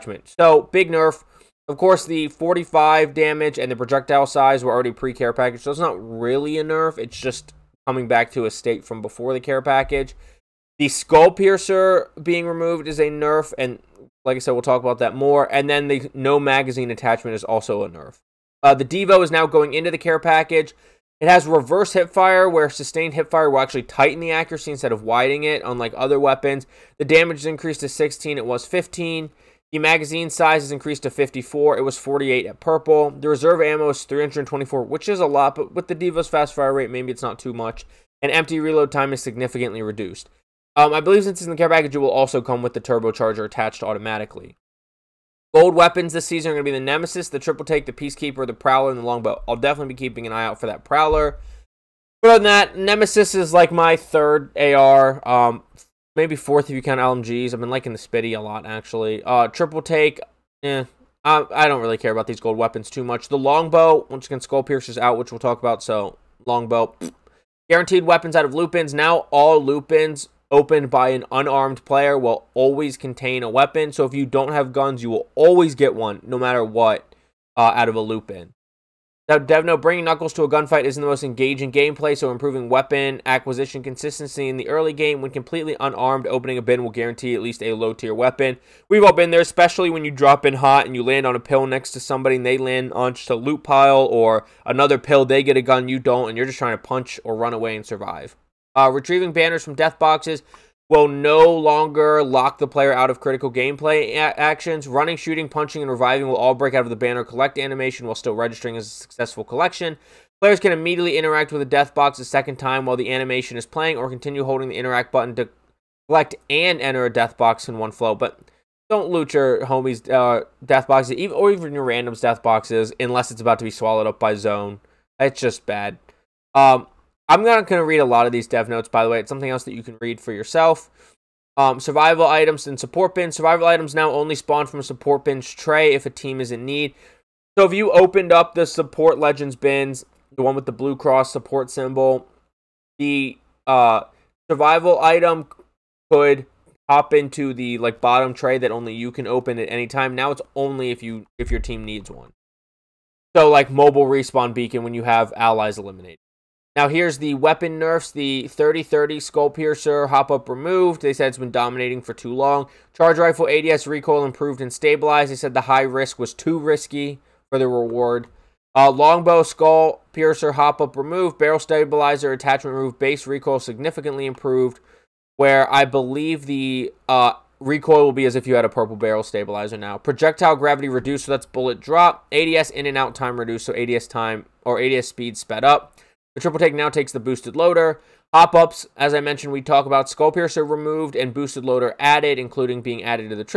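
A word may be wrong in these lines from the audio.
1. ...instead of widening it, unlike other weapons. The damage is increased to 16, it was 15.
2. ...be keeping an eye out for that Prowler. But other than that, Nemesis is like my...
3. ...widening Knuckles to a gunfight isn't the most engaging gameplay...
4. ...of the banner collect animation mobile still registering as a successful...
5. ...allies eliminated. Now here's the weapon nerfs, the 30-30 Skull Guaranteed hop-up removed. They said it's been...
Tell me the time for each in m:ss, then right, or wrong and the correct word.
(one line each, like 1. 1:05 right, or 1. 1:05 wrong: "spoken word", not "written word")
1. 0:24 right
2. 0:49 right
3. 1:19 wrong: "bringing", not "widening"
4. 1:46 wrong: "while", not "mobile"
5. 2:35 wrong: "Piercer", not "Guaranteed".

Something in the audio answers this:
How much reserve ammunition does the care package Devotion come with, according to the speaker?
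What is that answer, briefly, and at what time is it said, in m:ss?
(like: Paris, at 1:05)
324, at 0:34.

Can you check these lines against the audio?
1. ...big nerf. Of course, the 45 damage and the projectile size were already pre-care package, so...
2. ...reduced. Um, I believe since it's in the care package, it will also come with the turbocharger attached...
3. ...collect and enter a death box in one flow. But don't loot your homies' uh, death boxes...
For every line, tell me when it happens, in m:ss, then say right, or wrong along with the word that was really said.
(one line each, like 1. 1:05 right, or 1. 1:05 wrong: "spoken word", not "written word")
1. 0:00 right
2. 0:39 right
3. 1:56 right.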